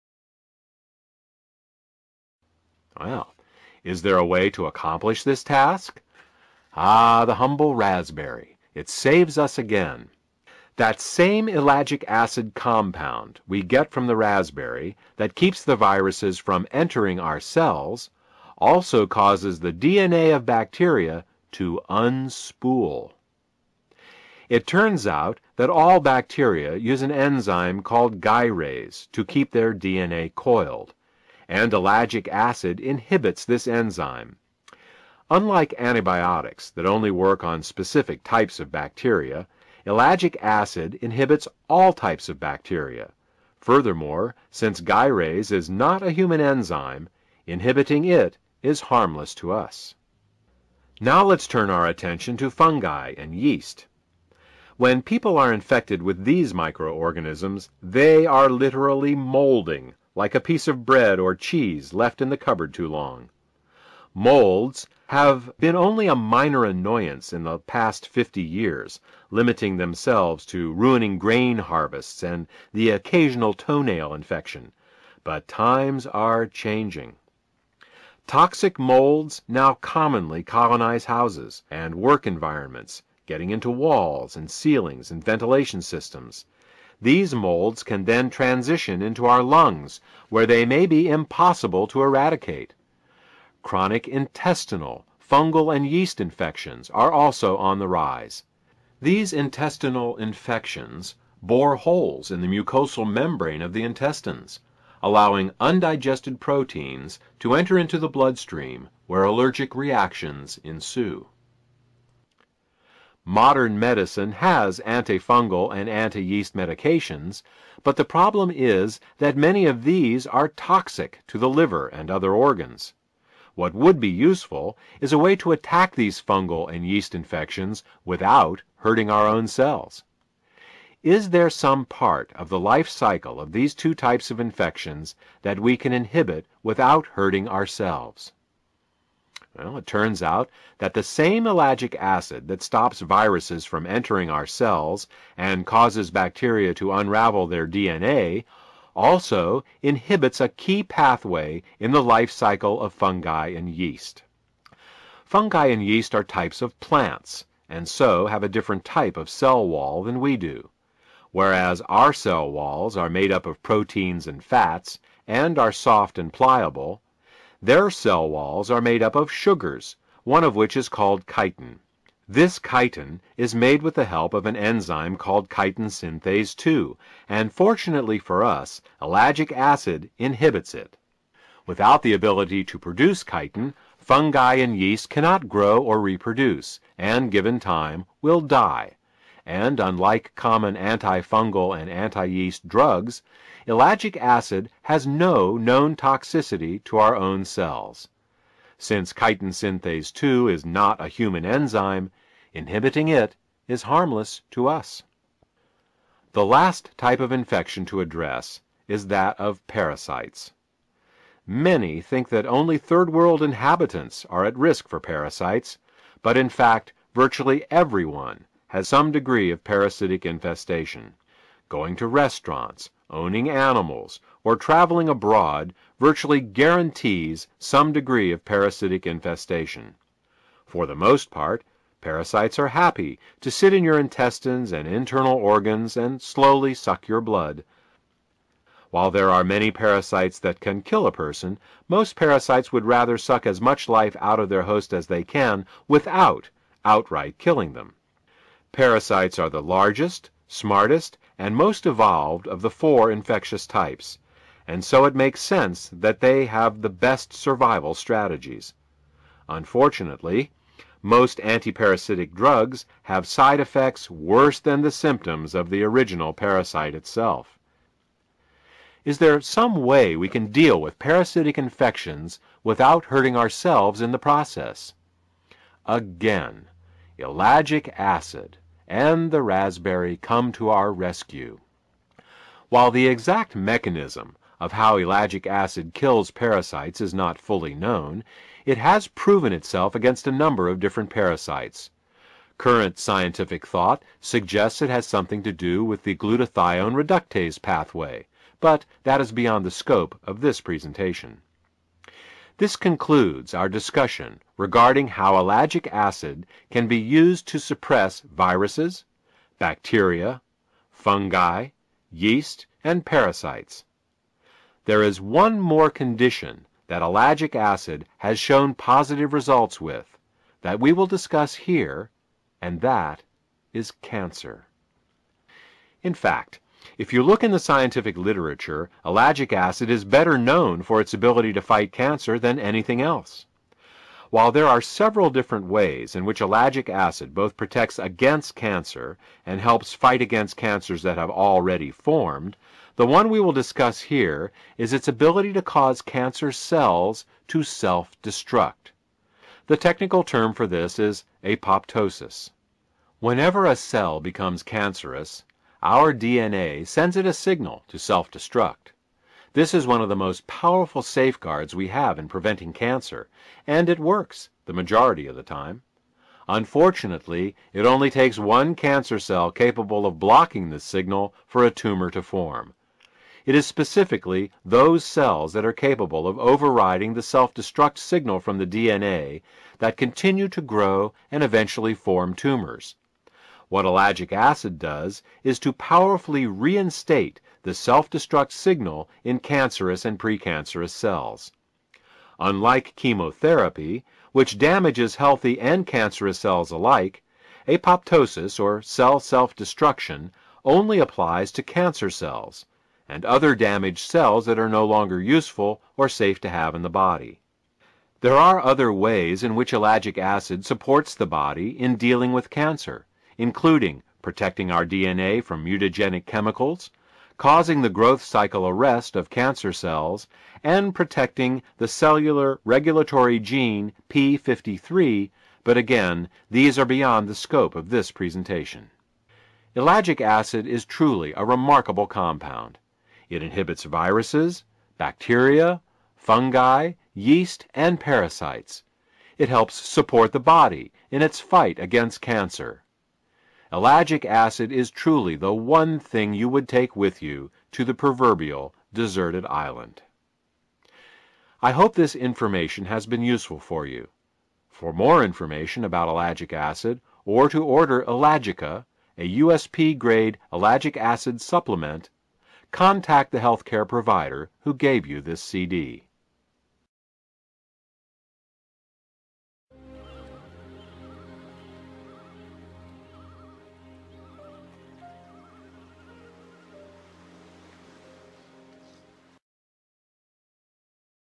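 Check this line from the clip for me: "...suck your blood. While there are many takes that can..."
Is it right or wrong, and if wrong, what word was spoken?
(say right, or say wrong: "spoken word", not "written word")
wrong: "parasites", not "takes".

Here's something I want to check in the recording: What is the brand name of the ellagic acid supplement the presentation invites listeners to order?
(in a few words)
Ellagica.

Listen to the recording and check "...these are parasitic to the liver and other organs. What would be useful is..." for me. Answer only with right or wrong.
wrong.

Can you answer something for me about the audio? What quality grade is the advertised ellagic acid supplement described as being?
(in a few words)
USP grade.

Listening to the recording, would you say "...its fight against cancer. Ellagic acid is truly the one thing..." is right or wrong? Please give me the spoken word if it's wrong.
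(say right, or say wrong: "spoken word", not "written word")
right.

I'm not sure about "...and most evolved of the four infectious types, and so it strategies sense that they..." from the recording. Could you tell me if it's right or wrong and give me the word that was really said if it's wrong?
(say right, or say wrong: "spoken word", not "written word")
wrong: "makes", not "strategies".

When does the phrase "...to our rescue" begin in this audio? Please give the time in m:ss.
4:40.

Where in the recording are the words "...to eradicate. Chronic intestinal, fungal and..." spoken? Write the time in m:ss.
1:31.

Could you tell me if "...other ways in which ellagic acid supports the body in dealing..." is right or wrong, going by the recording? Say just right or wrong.
right.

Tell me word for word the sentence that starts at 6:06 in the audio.
Unfortunately, it only takes one cancer cell capable of blocking this signal for a tumor to form.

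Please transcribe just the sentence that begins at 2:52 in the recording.
This chitin is made with the help of an enzyme called chitin synthase 2, and fortunately for us ellagic acid inhibits it.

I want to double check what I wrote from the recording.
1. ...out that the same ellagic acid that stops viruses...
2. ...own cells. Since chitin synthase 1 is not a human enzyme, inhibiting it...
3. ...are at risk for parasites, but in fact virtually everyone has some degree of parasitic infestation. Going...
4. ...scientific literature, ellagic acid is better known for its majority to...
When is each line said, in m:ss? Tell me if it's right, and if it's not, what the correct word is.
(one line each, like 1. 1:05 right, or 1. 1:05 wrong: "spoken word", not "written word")
1. 2:20 right
2. 3:17 wrong: "2", not "1"
3. 3:34 right
4. 5:27 wrong: "ability", not "majority".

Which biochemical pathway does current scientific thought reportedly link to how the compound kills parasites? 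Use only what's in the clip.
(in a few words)
glutathione reductase pathway.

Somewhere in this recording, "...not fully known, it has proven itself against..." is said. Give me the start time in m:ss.
4:47.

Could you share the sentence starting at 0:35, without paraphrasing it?
Unlike antibiotics that only work on specific types of bacteria, ellagic acid inhibits all types of bacteria.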